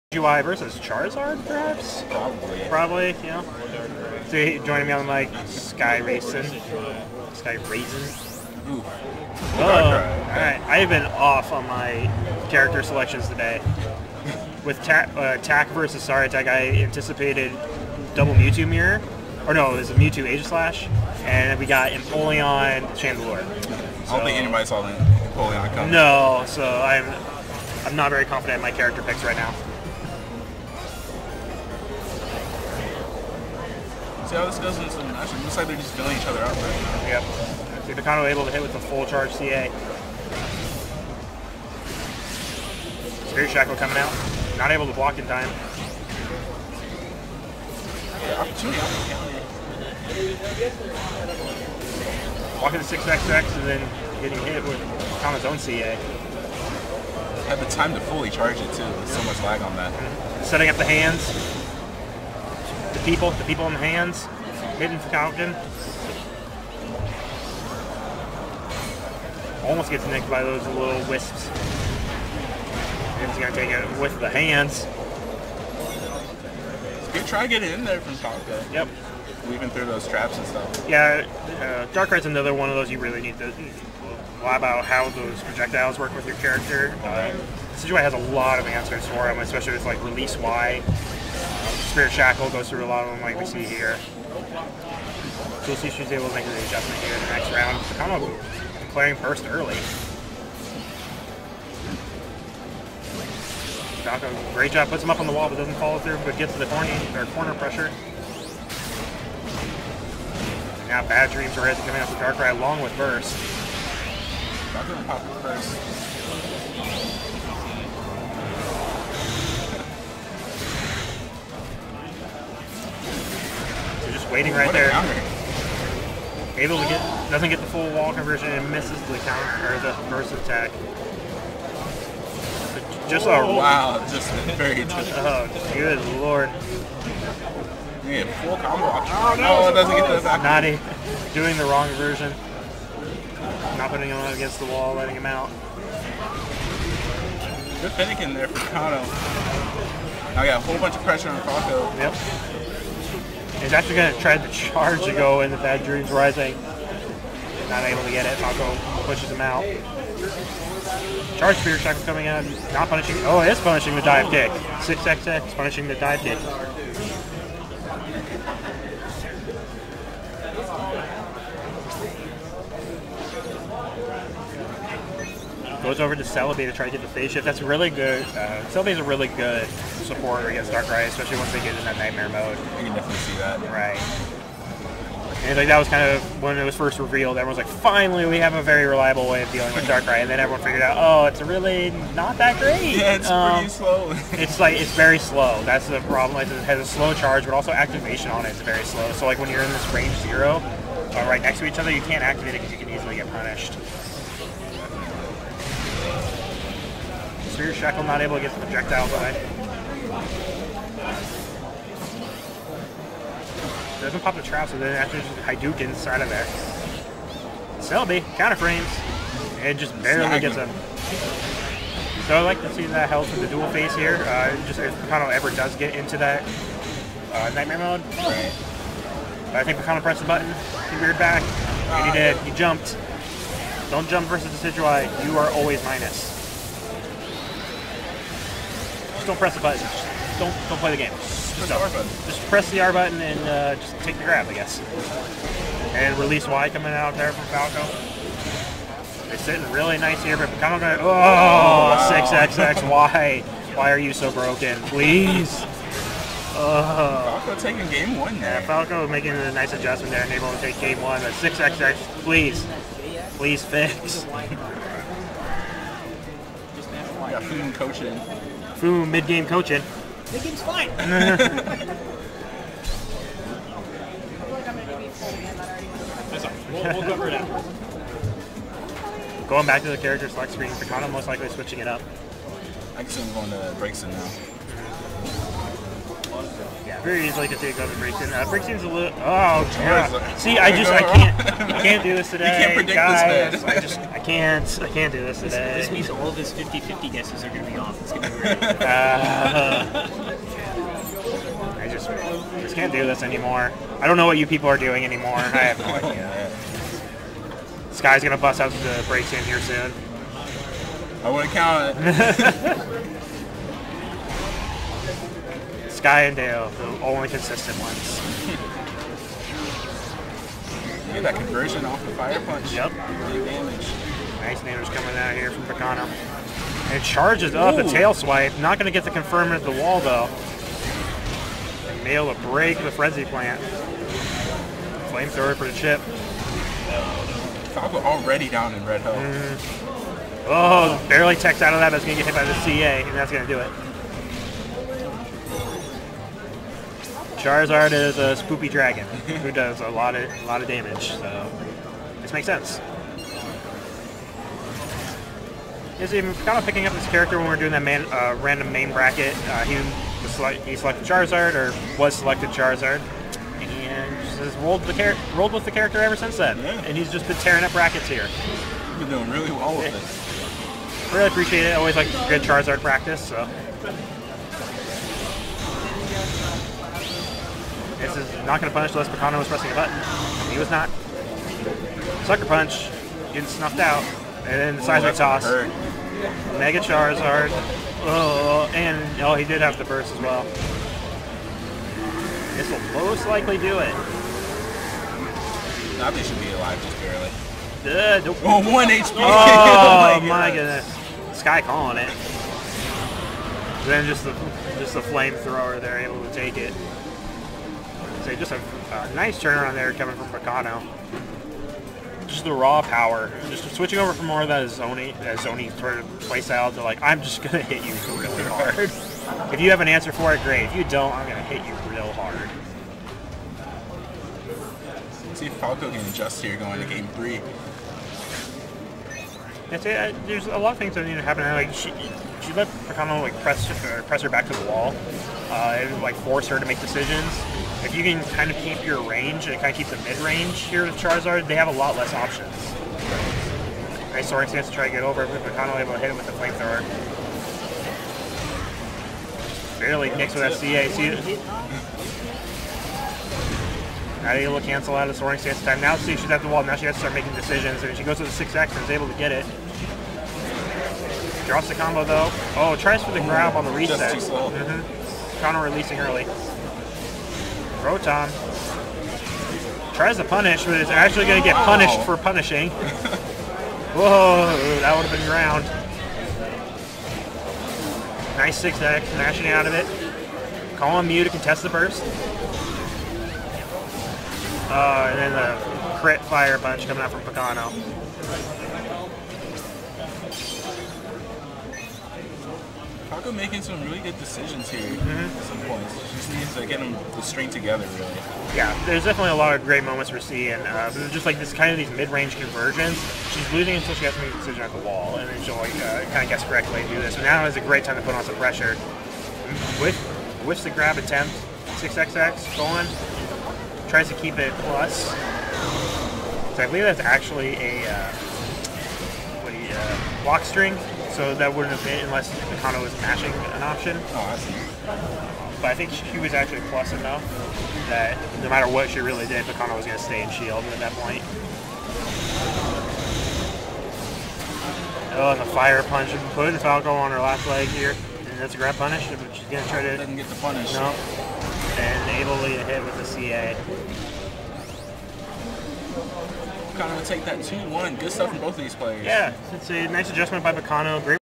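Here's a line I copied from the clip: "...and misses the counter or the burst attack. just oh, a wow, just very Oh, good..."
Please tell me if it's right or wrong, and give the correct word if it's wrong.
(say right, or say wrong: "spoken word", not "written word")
right.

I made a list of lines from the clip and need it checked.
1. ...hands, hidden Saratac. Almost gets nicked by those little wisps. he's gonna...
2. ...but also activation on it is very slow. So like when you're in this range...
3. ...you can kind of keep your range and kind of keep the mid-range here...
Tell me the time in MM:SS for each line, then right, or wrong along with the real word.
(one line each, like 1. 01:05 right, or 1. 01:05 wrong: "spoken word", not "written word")
1. 01:03 wrong: "Falcon", not "Saratac"
2. 03:17 right
3. 07:17 right.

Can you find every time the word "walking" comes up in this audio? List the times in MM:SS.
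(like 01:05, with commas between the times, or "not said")
00:52, 02:18.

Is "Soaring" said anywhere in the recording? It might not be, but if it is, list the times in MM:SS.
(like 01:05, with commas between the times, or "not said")
07:24, 07:35.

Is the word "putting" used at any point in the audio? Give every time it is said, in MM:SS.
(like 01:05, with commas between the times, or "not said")
02:23, 08:56.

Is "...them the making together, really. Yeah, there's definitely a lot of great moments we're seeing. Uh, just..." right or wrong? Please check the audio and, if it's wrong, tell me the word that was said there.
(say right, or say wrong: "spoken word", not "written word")
wrong: "string", not "making".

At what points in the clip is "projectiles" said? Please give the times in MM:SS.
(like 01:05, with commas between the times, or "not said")
01:25, 03:28.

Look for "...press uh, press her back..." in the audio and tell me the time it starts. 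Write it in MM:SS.
07:13.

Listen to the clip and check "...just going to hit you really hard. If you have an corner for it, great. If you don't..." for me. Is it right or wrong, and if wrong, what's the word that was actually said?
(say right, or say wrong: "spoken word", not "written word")
wrong: "answer", not "corner".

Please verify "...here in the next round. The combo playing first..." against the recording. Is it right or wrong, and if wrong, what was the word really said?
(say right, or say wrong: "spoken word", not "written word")
right.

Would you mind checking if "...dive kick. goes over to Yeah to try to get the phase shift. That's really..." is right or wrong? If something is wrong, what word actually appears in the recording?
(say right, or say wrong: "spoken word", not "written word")
wrong: "Celebi", not "Yeah".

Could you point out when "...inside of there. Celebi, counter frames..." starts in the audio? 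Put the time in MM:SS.
03:35.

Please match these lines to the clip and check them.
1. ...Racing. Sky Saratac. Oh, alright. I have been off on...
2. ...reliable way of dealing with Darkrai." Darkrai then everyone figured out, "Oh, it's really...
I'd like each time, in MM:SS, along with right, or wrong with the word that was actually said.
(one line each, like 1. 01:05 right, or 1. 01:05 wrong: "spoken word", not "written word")
1. 00:05 wrong: "Raisin", not "Saratac"
2. 03:08 wrong: "And", not "Darkrai".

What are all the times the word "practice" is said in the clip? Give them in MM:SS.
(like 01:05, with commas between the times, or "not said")
06:12.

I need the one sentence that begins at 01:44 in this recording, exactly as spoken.
Falco, great job, puts him up on the wall but doesn't follow through, but gets to the corny, or corner pressure.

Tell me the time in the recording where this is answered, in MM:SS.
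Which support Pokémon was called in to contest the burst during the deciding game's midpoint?
08:01.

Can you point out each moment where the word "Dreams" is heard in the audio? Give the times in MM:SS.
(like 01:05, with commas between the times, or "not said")
01:51, 02:35.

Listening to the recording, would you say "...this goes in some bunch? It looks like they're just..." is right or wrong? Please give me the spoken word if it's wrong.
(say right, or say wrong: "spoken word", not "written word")
wrong: "match", not "bunch".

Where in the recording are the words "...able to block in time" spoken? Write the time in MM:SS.
00:44.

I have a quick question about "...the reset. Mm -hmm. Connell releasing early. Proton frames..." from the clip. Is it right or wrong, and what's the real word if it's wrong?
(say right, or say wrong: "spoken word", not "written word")
wrong: "tries", not "frames".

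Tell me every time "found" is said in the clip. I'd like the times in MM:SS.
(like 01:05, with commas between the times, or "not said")
not said.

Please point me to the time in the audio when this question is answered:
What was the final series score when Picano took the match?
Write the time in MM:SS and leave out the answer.
09:07.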